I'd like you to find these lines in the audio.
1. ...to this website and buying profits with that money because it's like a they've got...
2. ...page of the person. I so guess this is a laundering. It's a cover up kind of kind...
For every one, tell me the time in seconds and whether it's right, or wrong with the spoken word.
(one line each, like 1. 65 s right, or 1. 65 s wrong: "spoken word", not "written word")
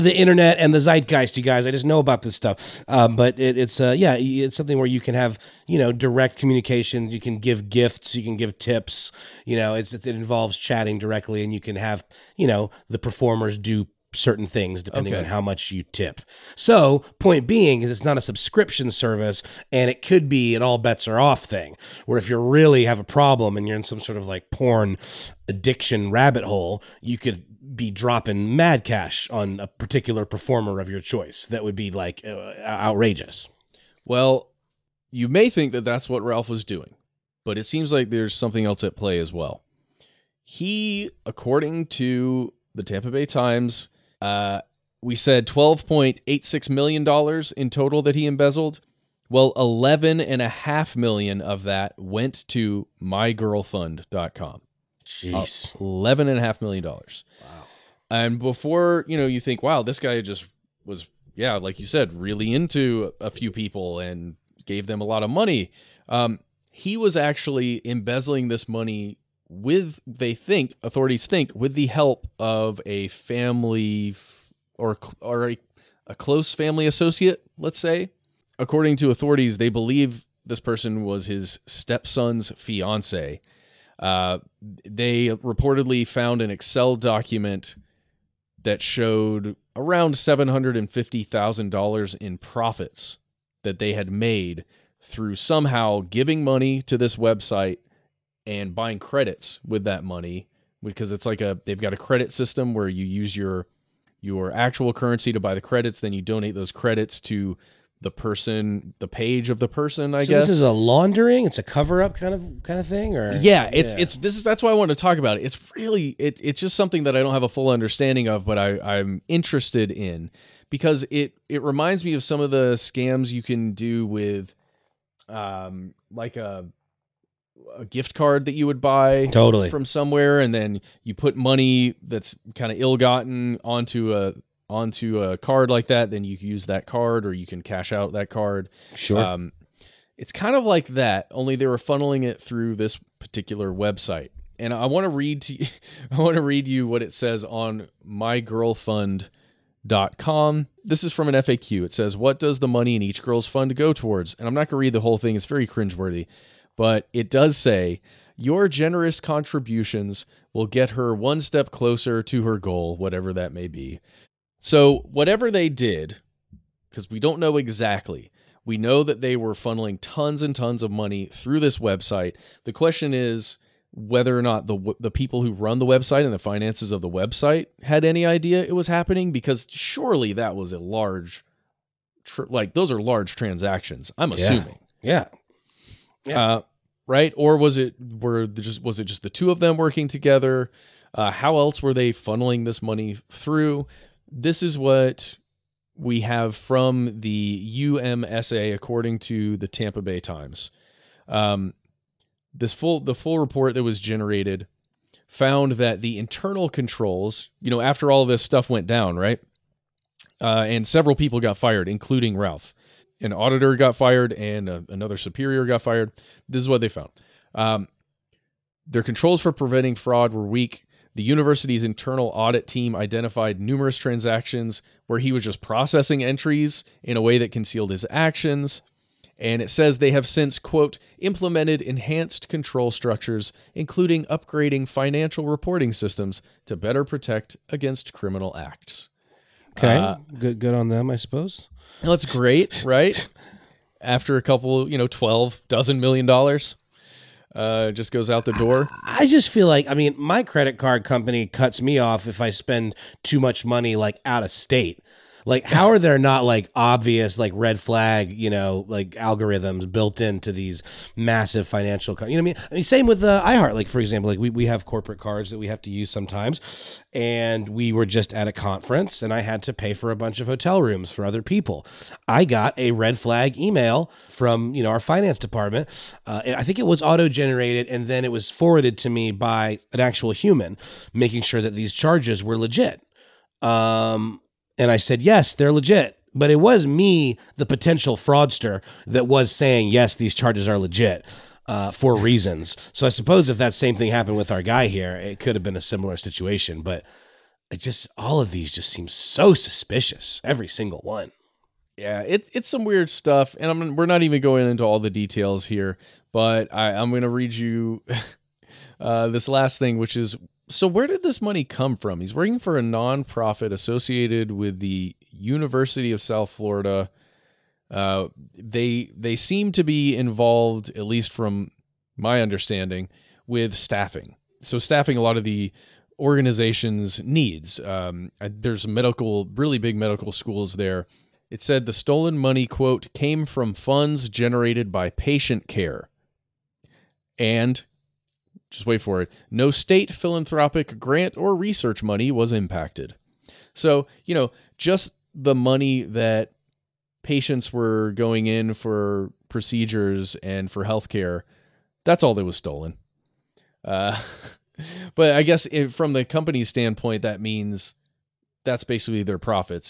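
1. 96 s wrong: "credits", not "profits"
2. 109 s right.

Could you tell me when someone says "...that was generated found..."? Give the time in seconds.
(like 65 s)
203 s.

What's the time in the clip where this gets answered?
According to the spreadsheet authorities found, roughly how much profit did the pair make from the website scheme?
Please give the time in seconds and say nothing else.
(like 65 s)
90 s.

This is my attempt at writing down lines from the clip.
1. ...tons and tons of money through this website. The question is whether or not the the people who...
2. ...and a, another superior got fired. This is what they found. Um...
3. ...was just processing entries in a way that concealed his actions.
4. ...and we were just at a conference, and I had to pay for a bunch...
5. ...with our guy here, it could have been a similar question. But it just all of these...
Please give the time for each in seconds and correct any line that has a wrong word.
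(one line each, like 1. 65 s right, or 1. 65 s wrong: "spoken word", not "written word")
1. 170 s right
2. 214 s right
3. 225 s right
4. 267 s right
5. 294 s wrong: "situation", not "question".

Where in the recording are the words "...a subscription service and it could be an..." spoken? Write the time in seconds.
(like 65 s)
18 s.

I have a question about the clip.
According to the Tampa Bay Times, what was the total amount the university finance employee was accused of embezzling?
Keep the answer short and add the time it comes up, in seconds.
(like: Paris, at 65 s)
$12.86 million, at 45 s.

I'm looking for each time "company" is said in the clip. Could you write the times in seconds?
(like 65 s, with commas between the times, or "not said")
251 s, 356 s.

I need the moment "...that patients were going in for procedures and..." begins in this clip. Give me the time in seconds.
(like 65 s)
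346 s.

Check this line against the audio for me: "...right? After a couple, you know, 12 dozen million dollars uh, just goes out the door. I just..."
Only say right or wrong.
right.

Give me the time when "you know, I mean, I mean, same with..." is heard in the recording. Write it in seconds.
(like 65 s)
262 s.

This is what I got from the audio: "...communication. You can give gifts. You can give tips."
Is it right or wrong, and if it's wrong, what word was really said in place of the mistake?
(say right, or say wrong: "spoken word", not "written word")
right.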